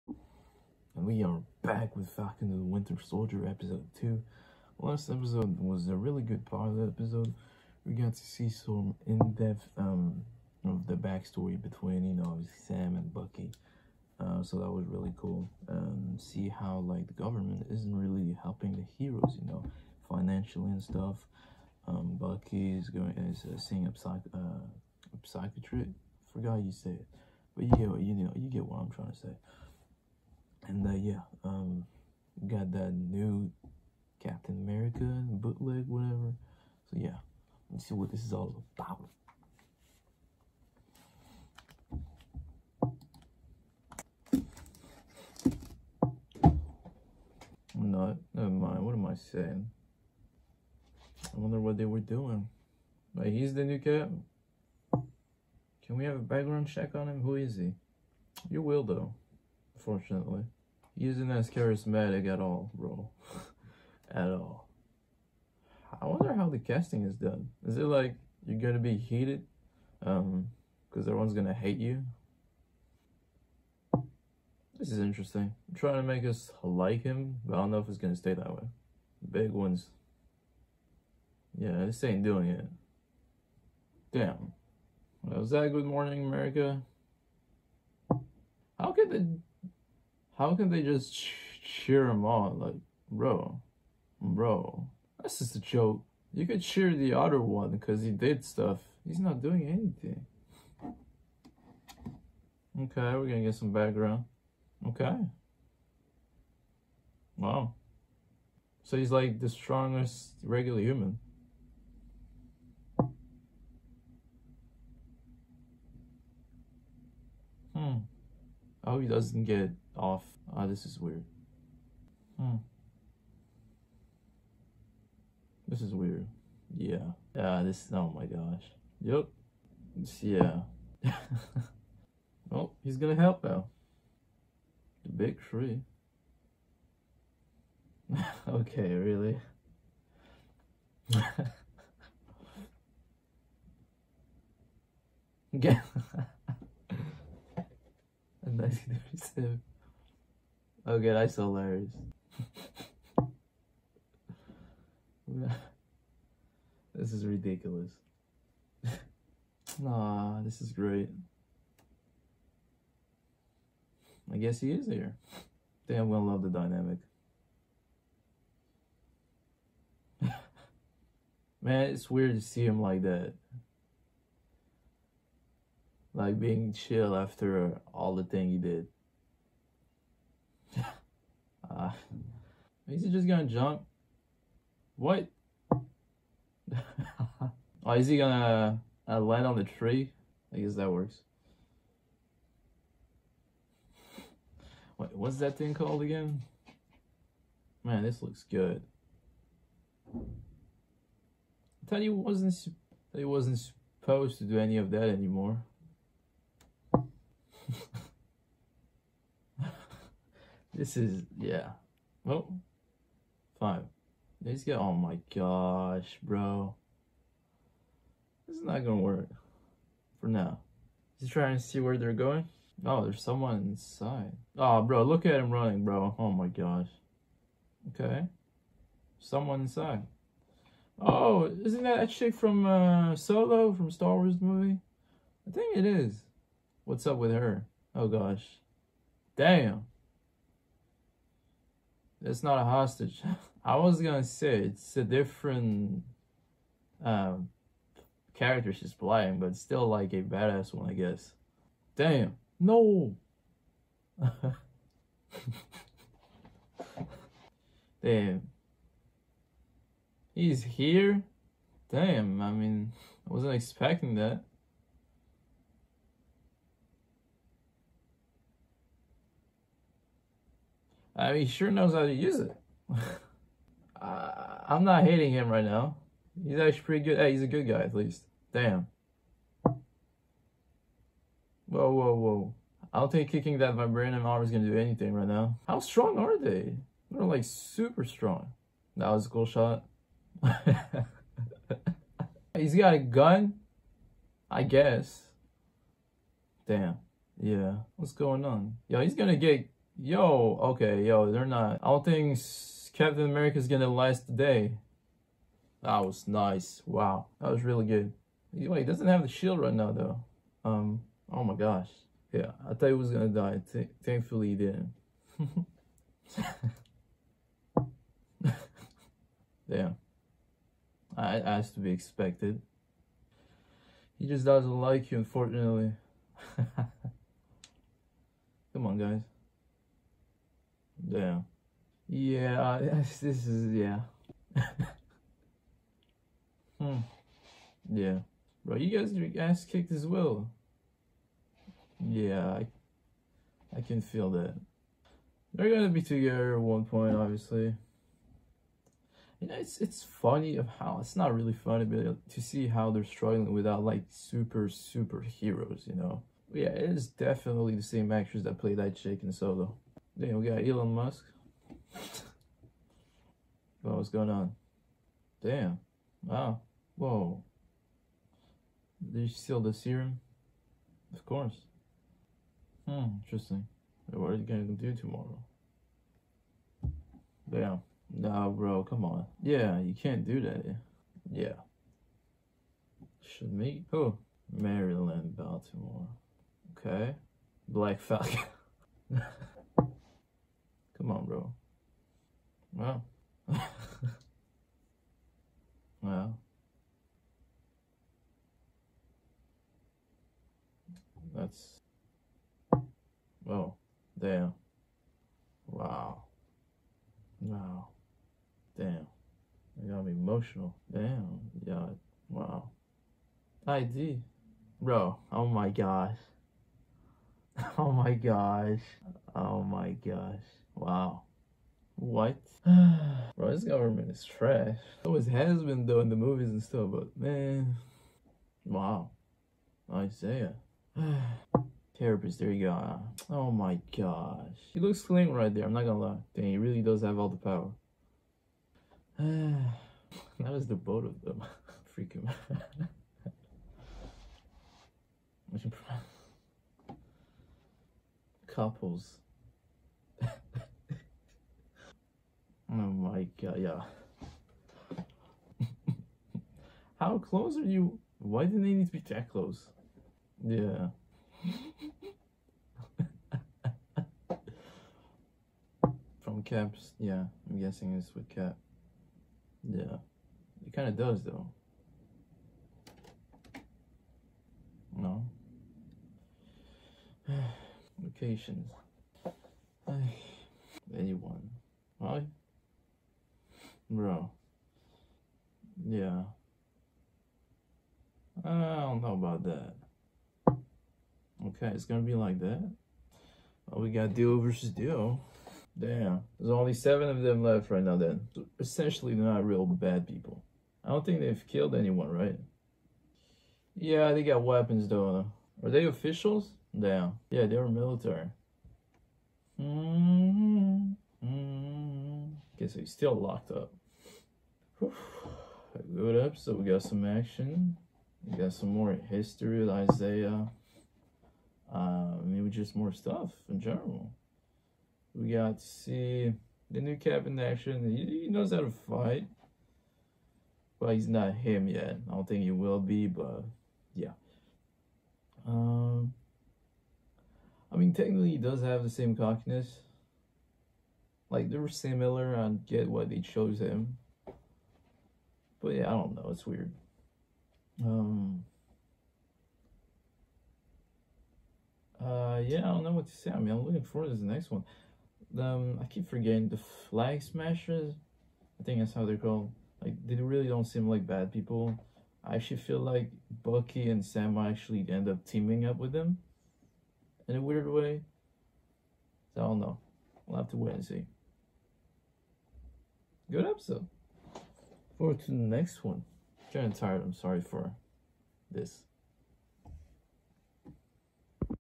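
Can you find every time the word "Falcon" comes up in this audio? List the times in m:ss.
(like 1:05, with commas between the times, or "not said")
0:02, 6:28.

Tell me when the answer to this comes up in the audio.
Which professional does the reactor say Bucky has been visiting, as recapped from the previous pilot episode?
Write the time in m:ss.
0:25.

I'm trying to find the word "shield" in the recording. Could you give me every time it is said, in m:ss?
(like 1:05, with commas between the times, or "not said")
5:09.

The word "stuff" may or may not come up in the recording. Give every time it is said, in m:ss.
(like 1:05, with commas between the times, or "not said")
0:20, 1:38, 7:06, 8:42.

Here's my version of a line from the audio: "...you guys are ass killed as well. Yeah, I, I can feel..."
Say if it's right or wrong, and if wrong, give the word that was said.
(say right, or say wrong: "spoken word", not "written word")
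wrong: "kicked", not "killed".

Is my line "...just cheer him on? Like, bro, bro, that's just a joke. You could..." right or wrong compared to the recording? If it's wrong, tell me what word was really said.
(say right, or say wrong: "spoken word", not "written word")
right.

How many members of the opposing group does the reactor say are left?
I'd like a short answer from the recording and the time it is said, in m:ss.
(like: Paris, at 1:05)
7, at 8:16.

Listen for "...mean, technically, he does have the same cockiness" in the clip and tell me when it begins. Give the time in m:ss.
8:57.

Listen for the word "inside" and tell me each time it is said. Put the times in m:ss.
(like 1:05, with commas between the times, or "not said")
3:43, 3:49.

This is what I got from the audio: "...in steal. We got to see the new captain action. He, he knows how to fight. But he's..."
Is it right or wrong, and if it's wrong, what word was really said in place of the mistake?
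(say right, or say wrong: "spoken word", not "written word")
wrong: "general", not "steal".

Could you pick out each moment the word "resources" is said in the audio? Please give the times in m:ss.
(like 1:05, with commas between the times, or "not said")
not said.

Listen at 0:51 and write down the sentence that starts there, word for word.
I wonder what they were doing.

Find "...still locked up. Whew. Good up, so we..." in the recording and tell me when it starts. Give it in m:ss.
8:32.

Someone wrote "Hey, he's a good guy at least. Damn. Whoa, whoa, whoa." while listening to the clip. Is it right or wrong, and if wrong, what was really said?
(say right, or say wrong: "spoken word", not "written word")
right.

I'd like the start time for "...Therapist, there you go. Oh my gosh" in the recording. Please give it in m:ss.
7:11.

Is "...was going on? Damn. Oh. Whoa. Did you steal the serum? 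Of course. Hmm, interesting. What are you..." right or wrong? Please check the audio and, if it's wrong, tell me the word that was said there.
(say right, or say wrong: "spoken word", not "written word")
right.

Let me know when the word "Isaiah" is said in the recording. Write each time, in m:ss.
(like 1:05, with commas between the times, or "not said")
7:09, 8:39.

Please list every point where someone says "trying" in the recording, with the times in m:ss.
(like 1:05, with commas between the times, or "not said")
0:28, 1:15, 3:41.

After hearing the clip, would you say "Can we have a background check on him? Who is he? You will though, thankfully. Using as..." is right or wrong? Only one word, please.
wrong.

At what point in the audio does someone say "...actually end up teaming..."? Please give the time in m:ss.
9:24.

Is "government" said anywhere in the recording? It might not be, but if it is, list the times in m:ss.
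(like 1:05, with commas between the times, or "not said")
0:17, 7:03.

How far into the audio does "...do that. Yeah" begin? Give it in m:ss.
6:20.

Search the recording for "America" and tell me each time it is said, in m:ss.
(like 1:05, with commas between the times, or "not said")
0:34, 1:26.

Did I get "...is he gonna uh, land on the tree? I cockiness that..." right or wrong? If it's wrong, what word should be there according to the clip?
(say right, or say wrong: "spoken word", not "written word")
wrong: "guess", not "cockiness".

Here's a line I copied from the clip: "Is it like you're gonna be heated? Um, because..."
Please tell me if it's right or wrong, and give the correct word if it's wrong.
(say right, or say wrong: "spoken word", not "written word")
right.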